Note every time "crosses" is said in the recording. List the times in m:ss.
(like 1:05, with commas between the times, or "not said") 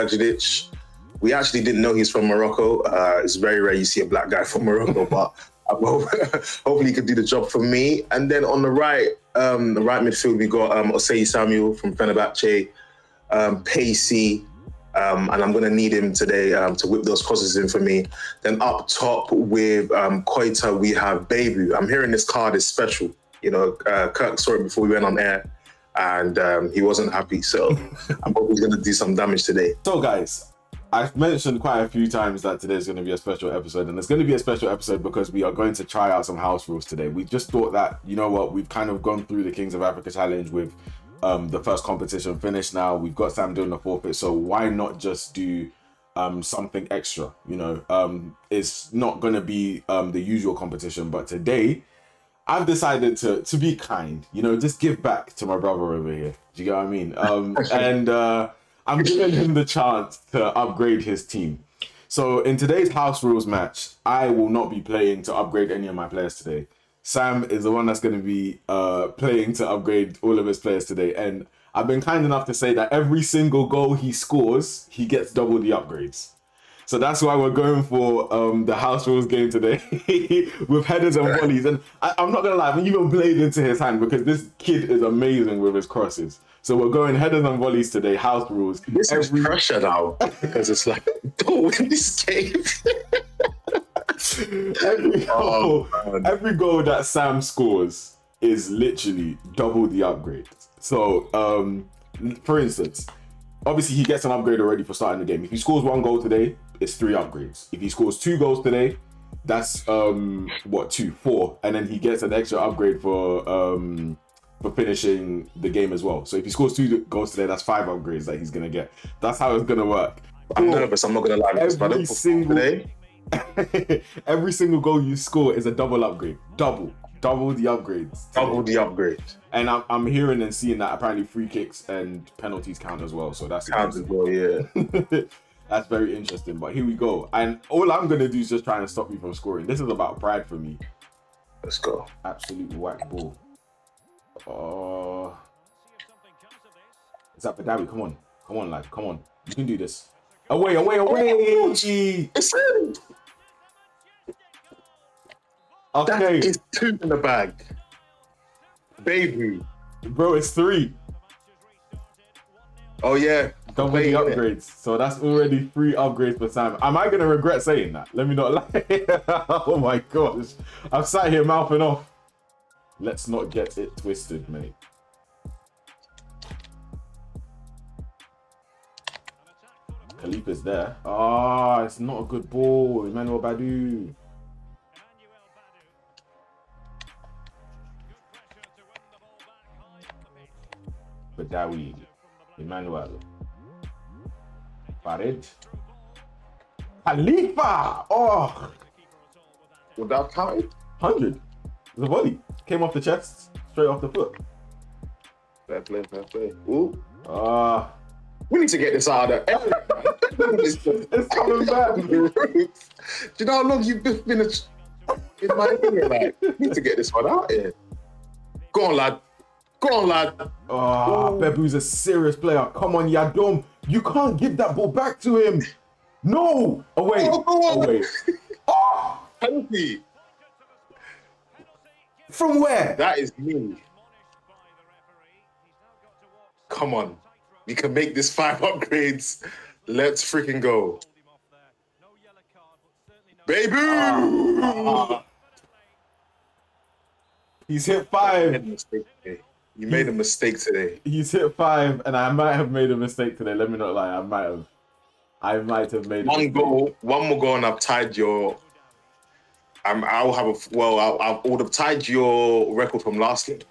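0:17, 1:25.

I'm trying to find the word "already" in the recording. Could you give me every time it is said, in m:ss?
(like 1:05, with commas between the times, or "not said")
1:44, 2:45.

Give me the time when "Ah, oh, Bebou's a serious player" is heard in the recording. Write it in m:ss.
3:40.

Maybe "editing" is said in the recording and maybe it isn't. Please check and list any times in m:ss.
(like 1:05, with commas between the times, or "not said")
not said.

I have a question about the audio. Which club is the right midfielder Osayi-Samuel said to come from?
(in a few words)
Fenerbahce.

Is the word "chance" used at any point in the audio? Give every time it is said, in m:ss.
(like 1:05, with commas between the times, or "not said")
0:59.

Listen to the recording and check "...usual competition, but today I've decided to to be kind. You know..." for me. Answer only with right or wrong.
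right.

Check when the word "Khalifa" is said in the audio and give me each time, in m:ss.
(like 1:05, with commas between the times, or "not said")
3:00, 3:17.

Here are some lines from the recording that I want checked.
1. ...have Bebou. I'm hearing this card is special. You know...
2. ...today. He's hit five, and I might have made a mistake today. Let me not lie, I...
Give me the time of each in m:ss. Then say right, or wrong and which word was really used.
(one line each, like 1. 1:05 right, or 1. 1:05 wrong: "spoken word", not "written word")
1. 0:20 right
2. 4:10 right.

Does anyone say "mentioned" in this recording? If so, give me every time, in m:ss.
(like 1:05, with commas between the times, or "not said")
0:31.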